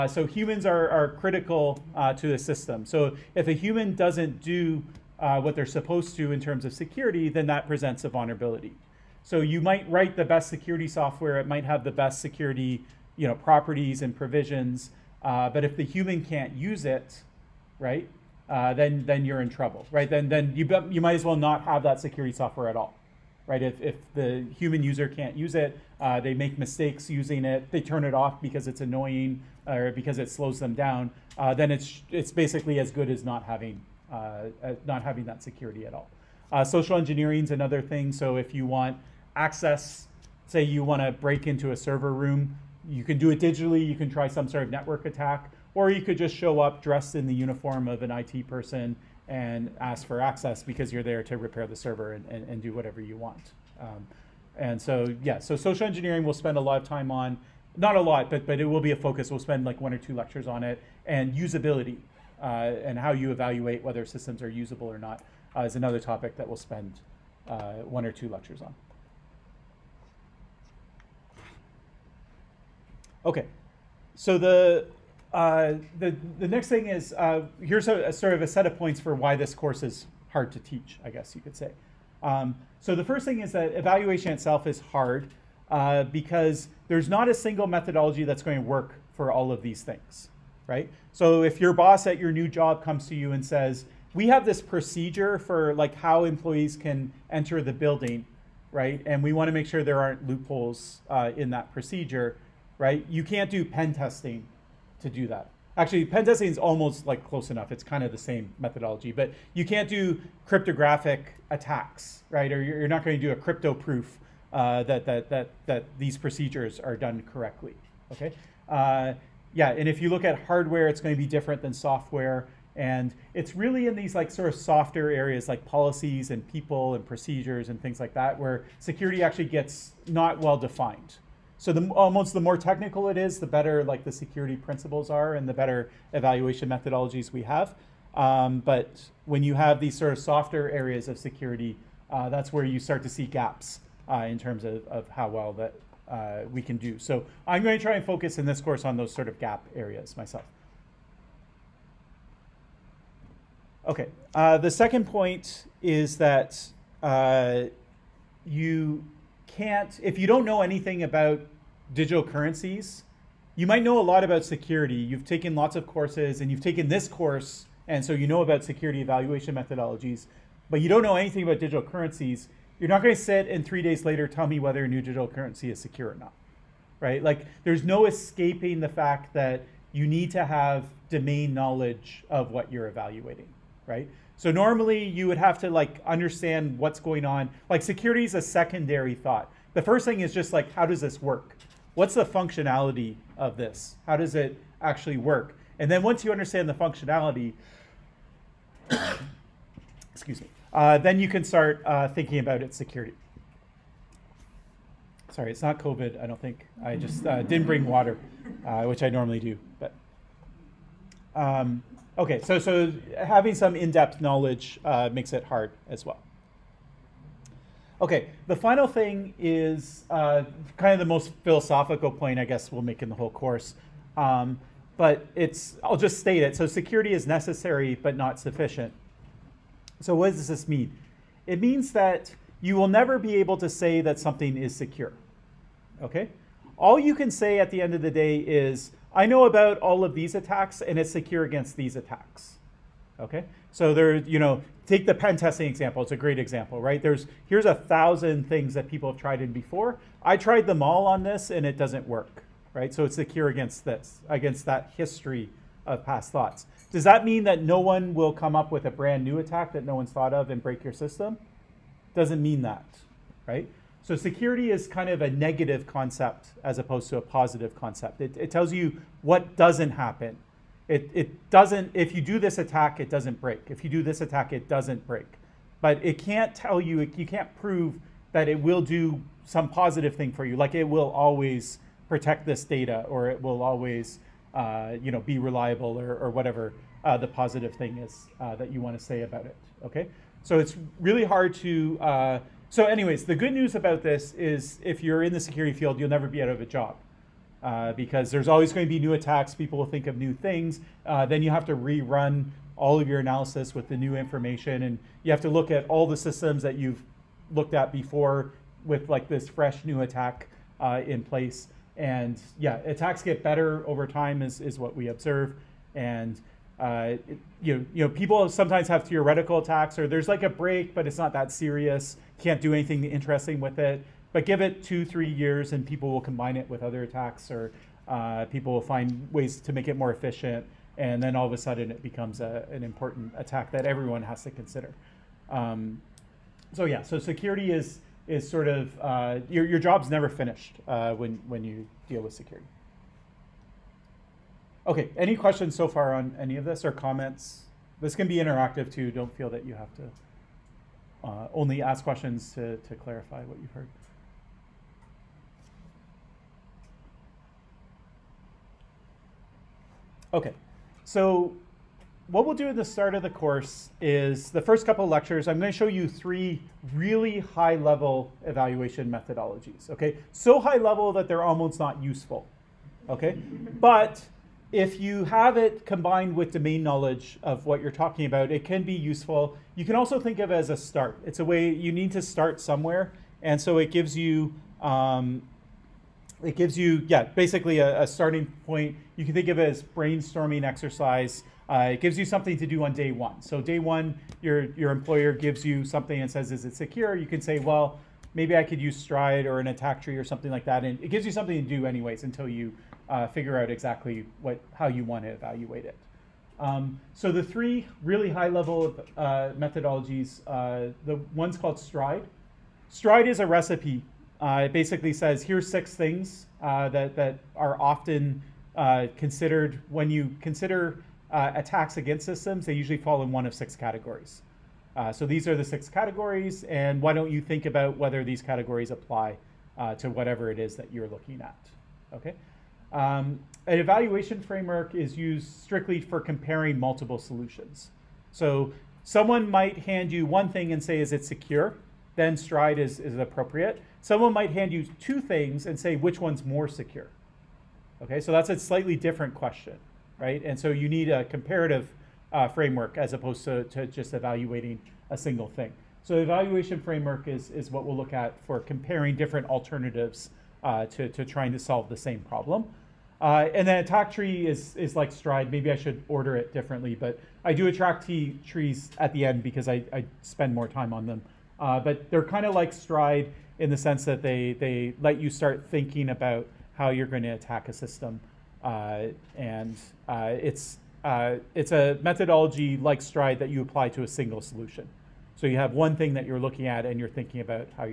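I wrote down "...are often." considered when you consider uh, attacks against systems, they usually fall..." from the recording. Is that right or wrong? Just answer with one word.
right.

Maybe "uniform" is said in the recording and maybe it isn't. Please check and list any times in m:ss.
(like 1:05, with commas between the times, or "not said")
0:47.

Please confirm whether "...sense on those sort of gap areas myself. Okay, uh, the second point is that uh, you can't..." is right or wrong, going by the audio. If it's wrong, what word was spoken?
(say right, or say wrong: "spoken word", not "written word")
wrong: "course", not "sense".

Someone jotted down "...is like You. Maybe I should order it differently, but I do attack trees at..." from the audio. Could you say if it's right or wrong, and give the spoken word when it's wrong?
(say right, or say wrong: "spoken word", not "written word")
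wrong: "STRIDE", not "You".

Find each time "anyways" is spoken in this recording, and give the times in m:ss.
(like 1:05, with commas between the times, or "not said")
4:52, 6:41.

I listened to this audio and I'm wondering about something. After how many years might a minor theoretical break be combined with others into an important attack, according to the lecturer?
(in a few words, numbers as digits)
2 or 3.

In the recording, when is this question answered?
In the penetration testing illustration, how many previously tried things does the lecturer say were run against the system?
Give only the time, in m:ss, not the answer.
4:07.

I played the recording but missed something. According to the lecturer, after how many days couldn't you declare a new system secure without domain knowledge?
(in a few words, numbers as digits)
3.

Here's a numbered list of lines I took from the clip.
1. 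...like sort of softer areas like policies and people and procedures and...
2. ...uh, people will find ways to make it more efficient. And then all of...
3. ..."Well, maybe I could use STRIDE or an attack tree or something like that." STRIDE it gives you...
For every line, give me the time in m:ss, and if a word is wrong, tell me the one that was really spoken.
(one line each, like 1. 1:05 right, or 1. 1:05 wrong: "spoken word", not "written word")
1. 2:04 right
2. 5:28 right
3. 6:37 wrong: "And", not "STRIDE".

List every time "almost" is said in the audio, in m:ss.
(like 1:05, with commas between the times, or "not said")
1:46, 2:11, 6:11.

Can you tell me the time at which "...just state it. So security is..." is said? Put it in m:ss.
3:45.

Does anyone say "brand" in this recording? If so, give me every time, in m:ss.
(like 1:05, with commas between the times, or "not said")
4:18.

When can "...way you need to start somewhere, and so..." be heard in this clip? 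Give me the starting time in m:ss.
6:21.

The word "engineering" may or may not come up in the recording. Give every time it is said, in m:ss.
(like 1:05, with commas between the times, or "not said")
0:36, 0:55.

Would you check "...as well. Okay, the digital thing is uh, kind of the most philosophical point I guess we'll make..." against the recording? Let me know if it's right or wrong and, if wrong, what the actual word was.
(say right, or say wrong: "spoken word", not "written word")
wrong: "final", not "digital".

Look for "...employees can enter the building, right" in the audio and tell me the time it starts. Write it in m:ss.
1:36.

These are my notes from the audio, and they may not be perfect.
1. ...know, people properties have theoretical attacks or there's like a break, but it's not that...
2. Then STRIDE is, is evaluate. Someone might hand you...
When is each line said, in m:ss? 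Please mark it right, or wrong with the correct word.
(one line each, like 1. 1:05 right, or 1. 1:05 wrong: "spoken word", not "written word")
1. 5:18 wrong: "sometimes", not "properties"
2. 7:22 wrong: "appropriate", not "evaluate".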